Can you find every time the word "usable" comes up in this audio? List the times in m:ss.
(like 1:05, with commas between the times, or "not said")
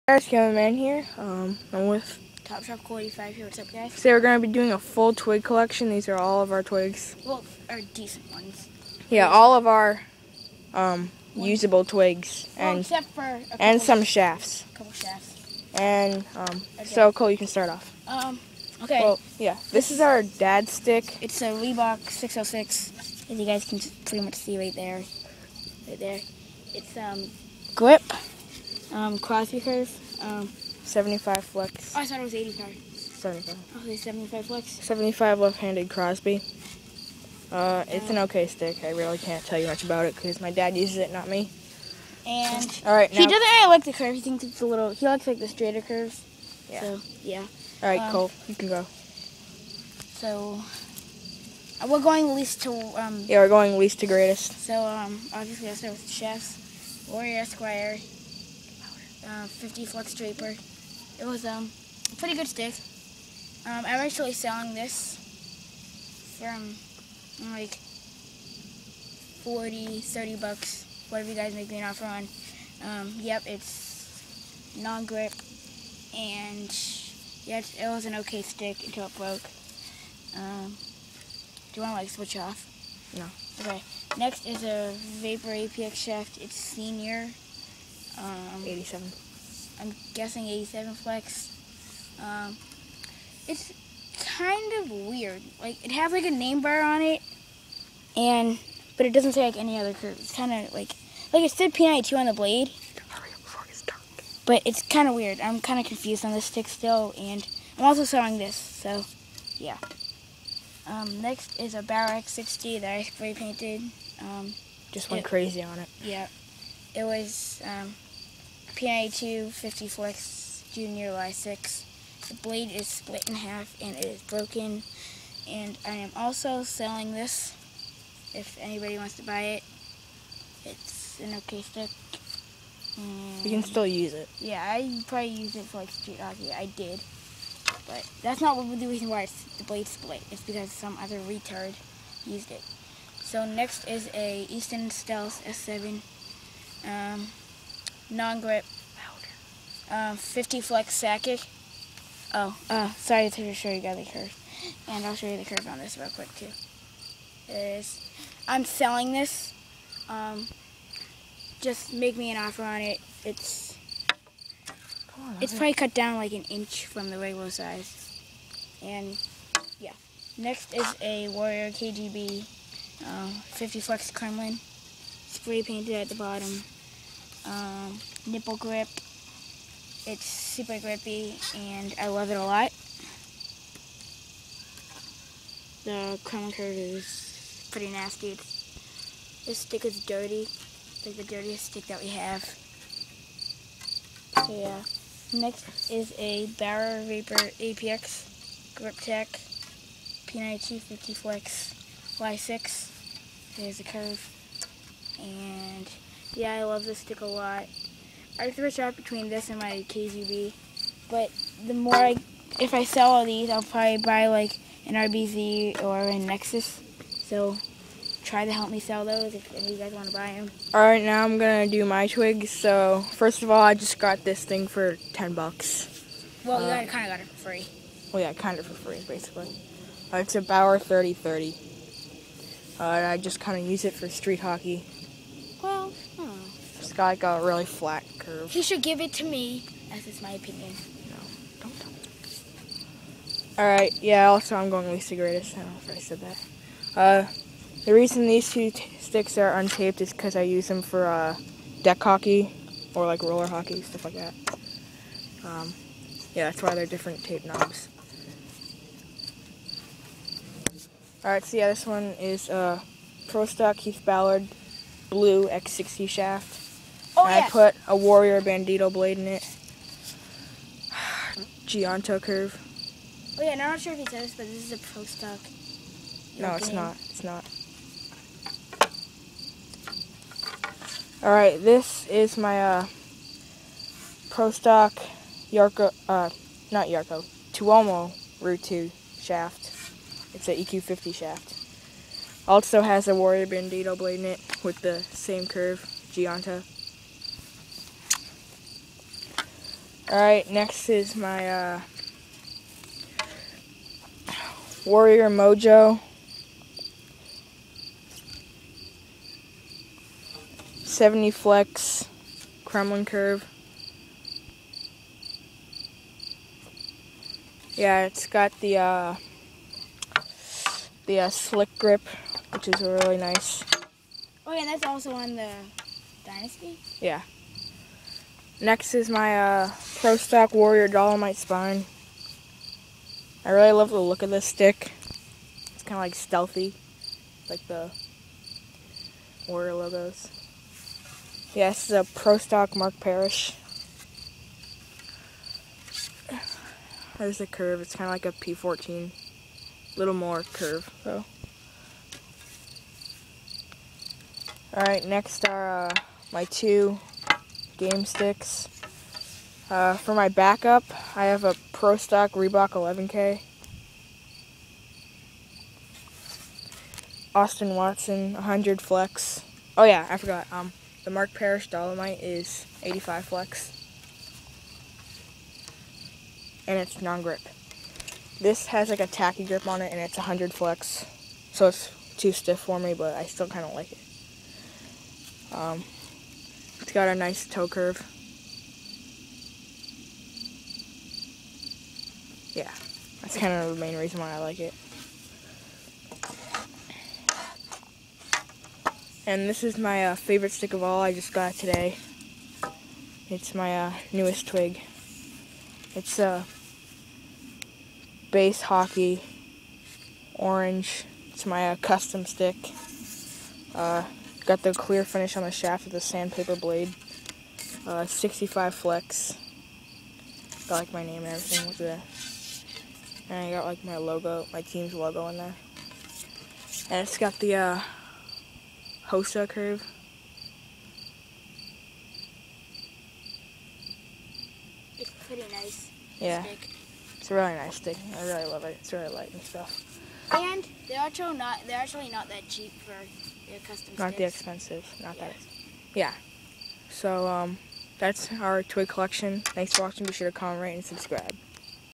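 0:11.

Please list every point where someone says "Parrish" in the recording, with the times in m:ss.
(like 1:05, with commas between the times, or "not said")
5:42, 6:11.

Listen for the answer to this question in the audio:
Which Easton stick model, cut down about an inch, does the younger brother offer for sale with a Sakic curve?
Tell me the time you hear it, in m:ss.
2:24.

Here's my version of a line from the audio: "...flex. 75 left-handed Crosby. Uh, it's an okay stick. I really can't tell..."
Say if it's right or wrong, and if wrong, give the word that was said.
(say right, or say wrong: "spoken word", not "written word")
right.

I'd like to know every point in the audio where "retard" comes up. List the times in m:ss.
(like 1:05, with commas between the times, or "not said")
2:21.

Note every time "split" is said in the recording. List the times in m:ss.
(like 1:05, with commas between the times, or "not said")
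2:02, 2:19.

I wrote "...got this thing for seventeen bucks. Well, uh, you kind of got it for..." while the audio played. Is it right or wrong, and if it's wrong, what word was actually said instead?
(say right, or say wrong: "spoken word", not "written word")
wrong: "ten", not "seventeen".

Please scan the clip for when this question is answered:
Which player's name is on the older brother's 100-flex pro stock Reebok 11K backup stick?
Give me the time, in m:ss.
6:07.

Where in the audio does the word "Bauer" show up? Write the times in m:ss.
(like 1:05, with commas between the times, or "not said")
3:16, 3:50.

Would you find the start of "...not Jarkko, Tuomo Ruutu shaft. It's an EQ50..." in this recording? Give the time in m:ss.
4:46.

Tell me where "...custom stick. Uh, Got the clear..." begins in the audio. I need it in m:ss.
6:51.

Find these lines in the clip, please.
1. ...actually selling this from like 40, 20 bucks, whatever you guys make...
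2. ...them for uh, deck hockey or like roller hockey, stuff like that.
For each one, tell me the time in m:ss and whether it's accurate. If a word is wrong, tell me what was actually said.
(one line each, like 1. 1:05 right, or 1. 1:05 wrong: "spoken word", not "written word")
1. 1:04 wrong: "30", not "20"
2. 4:10 right.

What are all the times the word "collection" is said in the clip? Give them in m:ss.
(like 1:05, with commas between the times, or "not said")
0:05, 7:28.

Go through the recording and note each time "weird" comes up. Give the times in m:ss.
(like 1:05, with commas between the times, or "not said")
1:34, 1:45.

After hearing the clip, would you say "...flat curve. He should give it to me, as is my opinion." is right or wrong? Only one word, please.
right.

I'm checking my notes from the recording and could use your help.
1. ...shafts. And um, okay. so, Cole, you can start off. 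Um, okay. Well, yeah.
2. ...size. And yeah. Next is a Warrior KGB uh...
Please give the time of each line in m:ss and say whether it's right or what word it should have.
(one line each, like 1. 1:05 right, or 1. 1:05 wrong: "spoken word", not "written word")
1. 0:14 right
2. 2:47 right.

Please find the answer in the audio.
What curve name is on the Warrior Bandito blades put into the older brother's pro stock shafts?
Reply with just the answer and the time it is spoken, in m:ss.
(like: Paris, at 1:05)
Gianto, at 4:31.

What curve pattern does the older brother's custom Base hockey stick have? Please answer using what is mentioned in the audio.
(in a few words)
Hossa.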